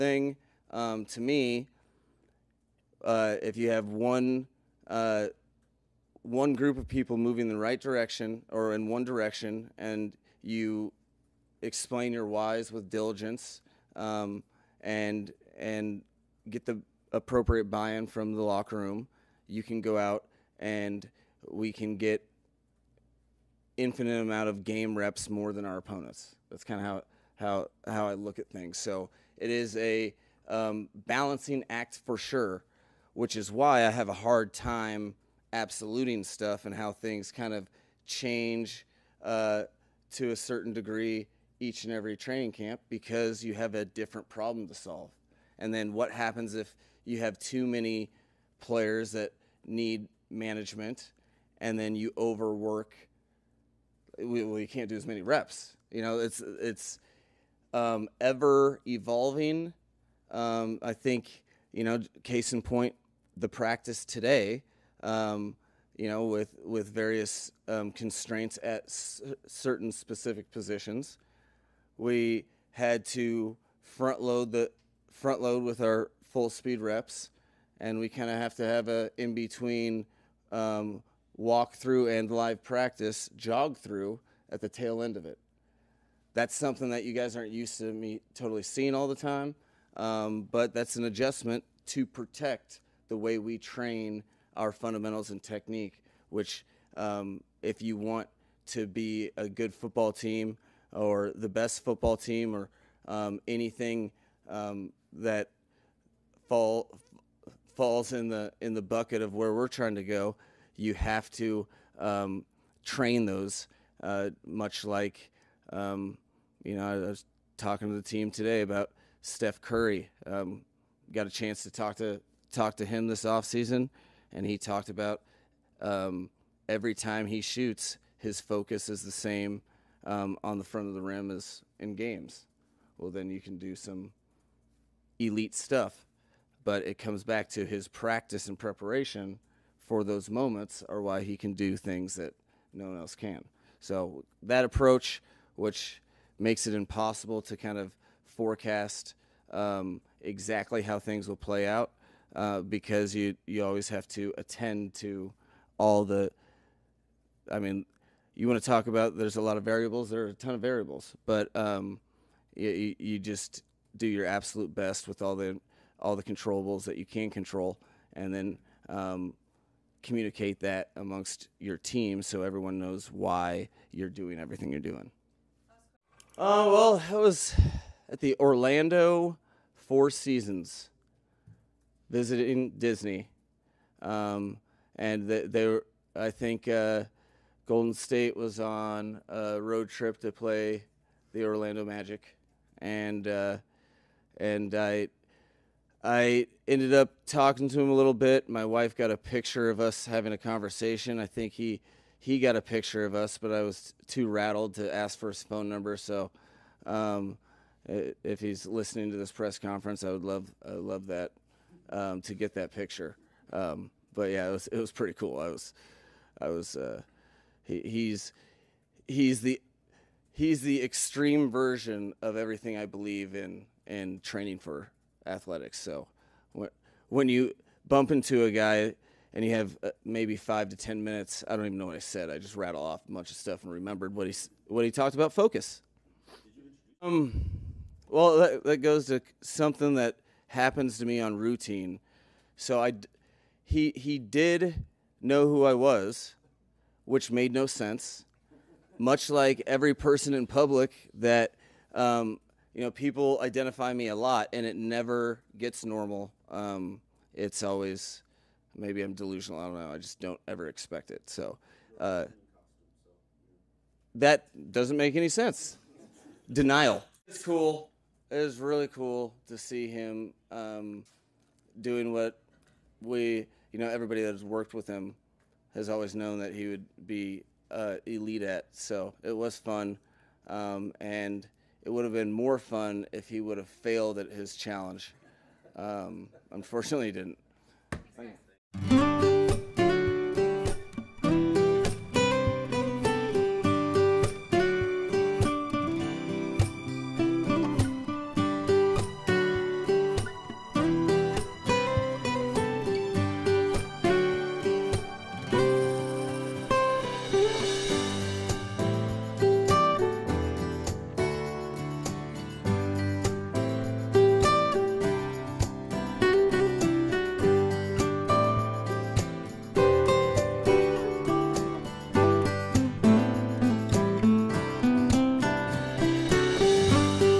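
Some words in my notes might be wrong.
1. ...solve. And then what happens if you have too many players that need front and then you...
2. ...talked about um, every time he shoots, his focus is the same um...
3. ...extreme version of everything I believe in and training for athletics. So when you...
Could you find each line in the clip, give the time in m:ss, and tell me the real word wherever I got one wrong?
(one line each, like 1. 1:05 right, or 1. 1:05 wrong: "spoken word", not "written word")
1. 0:44 wrong: "management", not "front"
2. 2:04 right
3. 3:40 right.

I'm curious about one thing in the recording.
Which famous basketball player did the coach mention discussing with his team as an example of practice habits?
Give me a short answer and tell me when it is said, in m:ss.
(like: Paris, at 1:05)
Steph Curry, at 1:59.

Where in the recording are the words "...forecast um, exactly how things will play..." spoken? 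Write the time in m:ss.
2:28.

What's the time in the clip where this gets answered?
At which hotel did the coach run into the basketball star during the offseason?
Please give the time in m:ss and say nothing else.
2:58.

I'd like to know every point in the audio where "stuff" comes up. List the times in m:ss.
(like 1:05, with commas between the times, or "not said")
0:36, 2:15, 3:53.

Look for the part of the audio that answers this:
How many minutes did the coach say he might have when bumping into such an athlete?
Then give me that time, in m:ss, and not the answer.
3:50.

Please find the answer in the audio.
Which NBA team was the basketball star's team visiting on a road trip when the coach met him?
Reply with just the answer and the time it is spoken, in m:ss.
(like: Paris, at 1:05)
Orlando Magic, at 3:11.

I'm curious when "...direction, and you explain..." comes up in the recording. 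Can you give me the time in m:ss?
0:09.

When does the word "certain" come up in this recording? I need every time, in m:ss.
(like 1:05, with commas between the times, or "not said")
0:40, 1:09.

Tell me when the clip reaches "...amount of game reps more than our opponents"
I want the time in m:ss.
0:24.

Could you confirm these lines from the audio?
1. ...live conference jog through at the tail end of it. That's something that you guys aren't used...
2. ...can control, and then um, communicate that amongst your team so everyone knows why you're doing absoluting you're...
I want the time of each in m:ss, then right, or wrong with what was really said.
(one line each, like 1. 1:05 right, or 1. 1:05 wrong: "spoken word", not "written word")
1. 1:22 wrong: "practice", not "conference"
2. 2:47 wrong: "everything", not "absoluting".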